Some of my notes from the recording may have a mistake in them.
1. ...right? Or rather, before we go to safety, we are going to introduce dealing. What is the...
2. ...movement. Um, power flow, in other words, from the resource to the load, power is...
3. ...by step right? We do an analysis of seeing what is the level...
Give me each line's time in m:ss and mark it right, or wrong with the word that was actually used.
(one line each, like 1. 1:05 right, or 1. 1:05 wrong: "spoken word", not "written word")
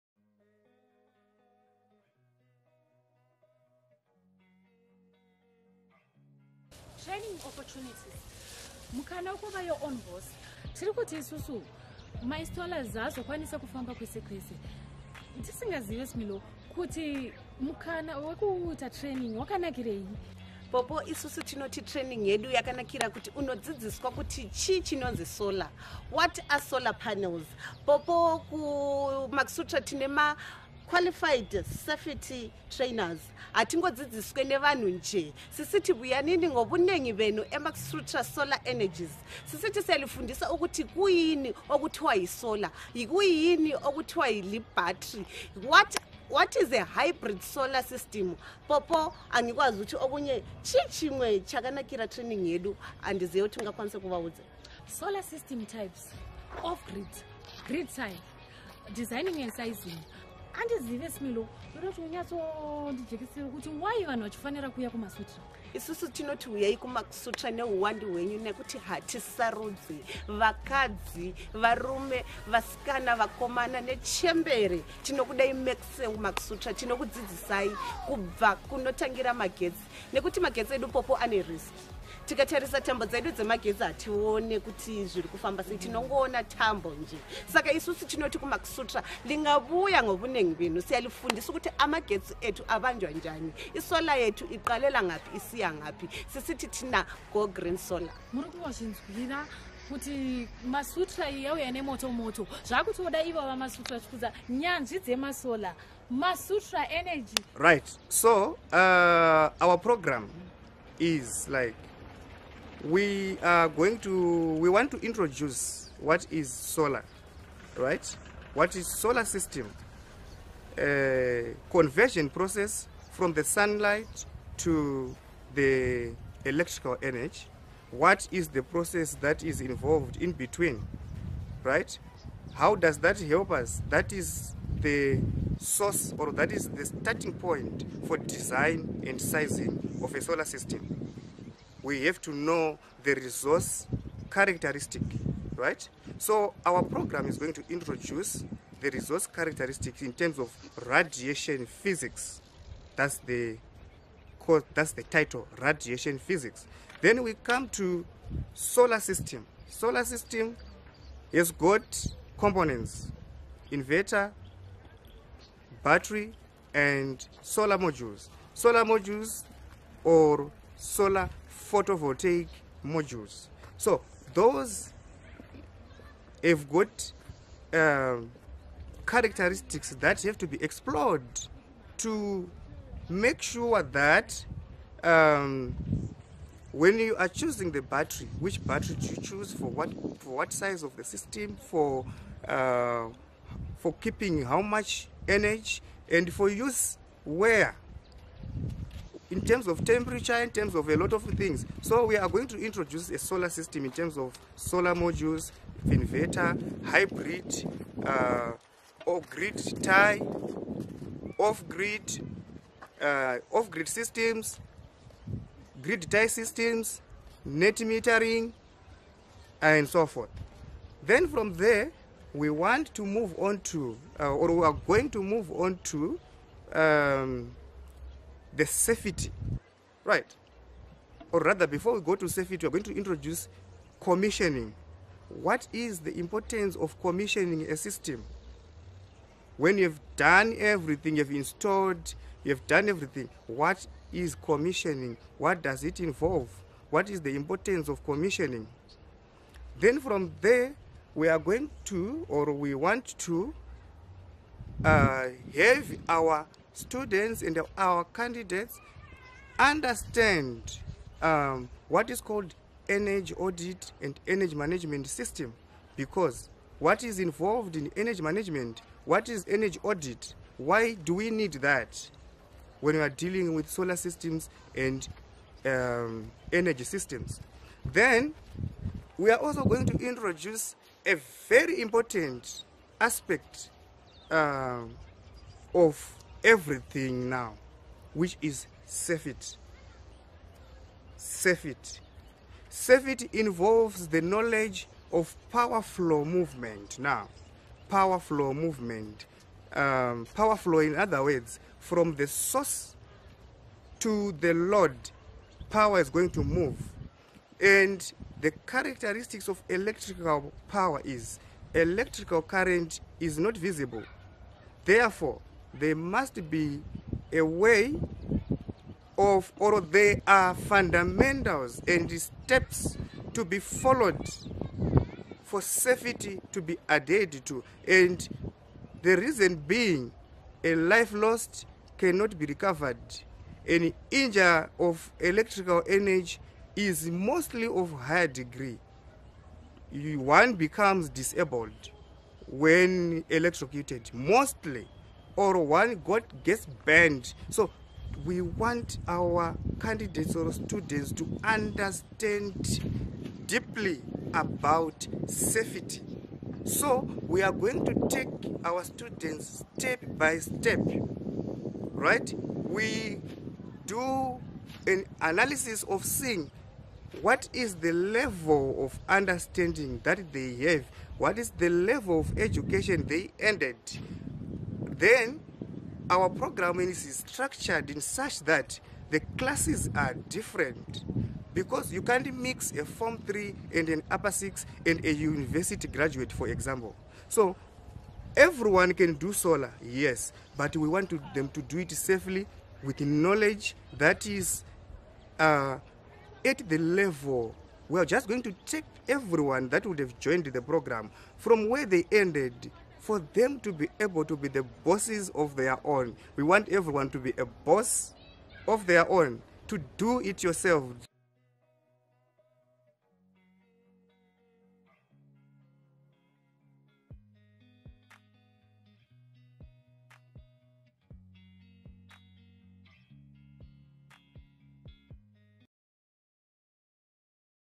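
1. 3:50 wrong: "commissioning", not "dealing"
2. 4:58 wrong: "source", not "resource"
3. 6:00 right.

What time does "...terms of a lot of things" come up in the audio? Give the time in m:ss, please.
3:20.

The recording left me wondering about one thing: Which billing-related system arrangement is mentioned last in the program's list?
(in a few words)
Net metering.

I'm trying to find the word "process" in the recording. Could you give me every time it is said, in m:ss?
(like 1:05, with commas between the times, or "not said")
2:02, 2:08.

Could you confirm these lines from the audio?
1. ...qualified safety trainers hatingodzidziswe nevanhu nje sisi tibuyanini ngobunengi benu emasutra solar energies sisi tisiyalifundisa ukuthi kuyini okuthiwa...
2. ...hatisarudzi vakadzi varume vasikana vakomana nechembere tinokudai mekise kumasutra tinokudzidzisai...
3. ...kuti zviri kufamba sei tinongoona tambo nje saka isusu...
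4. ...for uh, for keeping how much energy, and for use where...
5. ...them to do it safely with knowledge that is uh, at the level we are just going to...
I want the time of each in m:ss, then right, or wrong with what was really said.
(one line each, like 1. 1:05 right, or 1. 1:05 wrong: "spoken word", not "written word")
1. 0:30 right
2. 1:08 right
3. 1:24 right
4. 3:11 right
5. 6:31 right.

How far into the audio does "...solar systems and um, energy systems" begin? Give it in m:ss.
4:33.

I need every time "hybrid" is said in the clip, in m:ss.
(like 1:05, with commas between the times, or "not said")
0:46, 3:26.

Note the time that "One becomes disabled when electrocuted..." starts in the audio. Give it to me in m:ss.
5:39.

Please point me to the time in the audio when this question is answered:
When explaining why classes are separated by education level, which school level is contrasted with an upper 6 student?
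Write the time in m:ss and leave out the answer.
6:22.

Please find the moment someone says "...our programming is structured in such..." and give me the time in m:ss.
6:16.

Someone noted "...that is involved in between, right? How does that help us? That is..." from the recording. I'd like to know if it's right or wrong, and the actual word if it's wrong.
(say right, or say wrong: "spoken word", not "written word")
right.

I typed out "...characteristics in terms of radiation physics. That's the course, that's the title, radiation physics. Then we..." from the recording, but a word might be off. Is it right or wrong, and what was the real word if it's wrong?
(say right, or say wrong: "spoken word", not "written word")
right.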